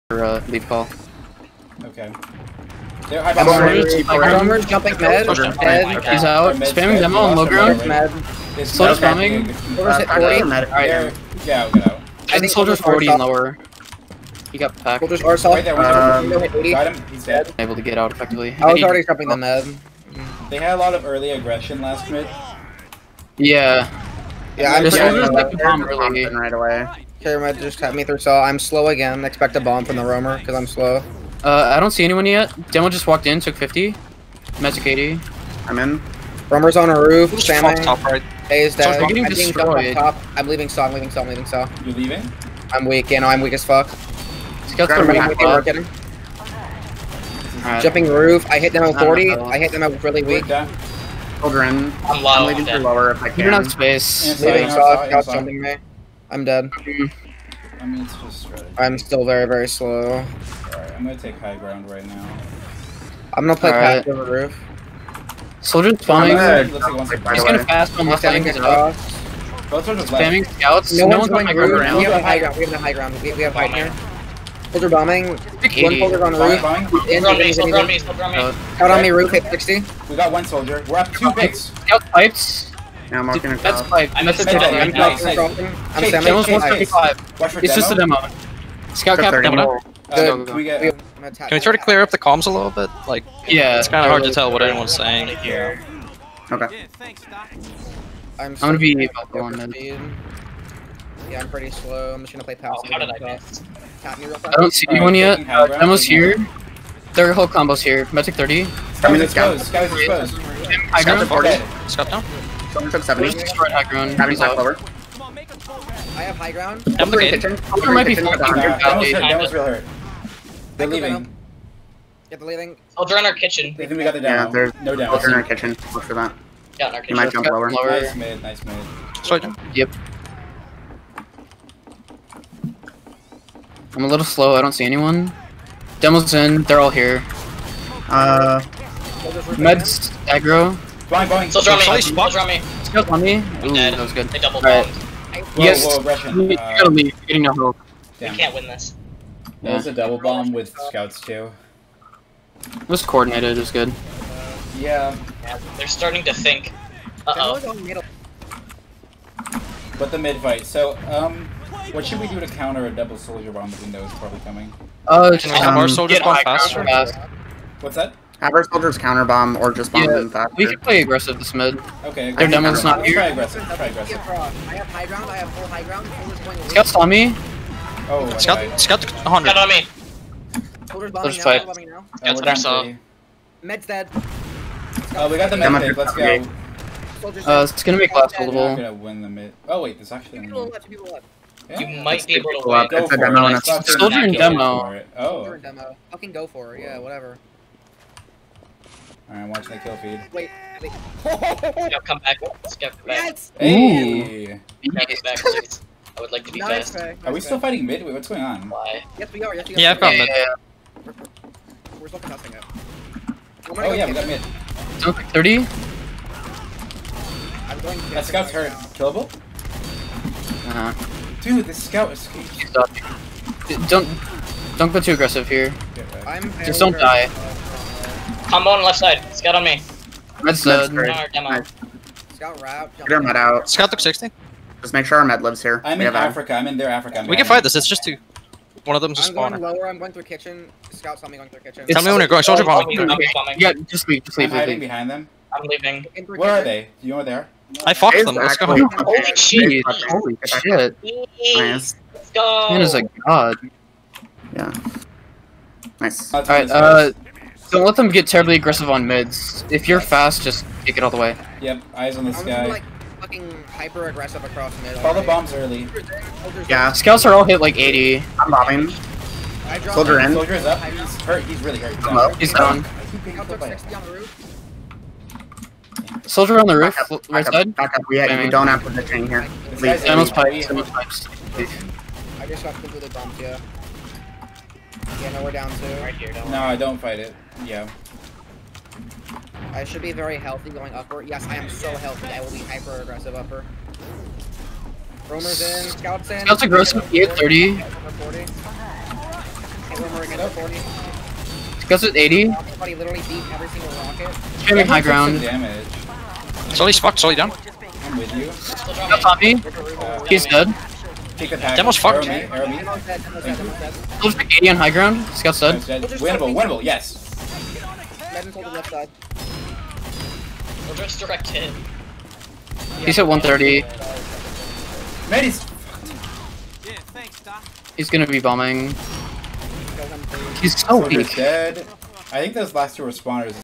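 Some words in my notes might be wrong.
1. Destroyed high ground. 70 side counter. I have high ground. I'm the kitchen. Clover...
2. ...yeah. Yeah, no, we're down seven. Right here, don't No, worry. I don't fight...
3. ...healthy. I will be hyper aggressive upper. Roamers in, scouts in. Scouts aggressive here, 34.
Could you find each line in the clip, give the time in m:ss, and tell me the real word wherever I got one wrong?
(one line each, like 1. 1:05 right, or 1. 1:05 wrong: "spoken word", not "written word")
1. 1:53 wrong: "clover", not "counter"
2. 4:43 wrong: "two", not "seven"
3. 4:51 wrong: "30", not "34".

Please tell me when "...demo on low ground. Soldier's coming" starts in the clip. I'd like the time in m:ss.
0:06.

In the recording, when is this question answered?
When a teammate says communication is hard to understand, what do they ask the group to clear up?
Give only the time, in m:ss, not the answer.
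1:31.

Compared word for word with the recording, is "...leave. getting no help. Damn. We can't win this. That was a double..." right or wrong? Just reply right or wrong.
right.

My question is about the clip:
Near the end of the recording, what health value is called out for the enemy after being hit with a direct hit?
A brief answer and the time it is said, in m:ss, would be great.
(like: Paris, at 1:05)
130, at 5:23.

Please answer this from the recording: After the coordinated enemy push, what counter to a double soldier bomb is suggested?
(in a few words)
Our soldiers bomb faster.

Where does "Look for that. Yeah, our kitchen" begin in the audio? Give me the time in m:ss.
2:05.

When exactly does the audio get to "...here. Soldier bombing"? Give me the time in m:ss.
1:13.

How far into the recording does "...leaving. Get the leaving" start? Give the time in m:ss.
2:00.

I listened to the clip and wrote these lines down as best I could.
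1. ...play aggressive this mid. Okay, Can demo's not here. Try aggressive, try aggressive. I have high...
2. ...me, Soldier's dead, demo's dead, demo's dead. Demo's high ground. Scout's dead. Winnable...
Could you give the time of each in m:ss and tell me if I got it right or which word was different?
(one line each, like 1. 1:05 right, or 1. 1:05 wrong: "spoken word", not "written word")
1. 2:50 wrong: "Their", not "Can"
2. 5:12 wrong: "Demo", not "Soldier".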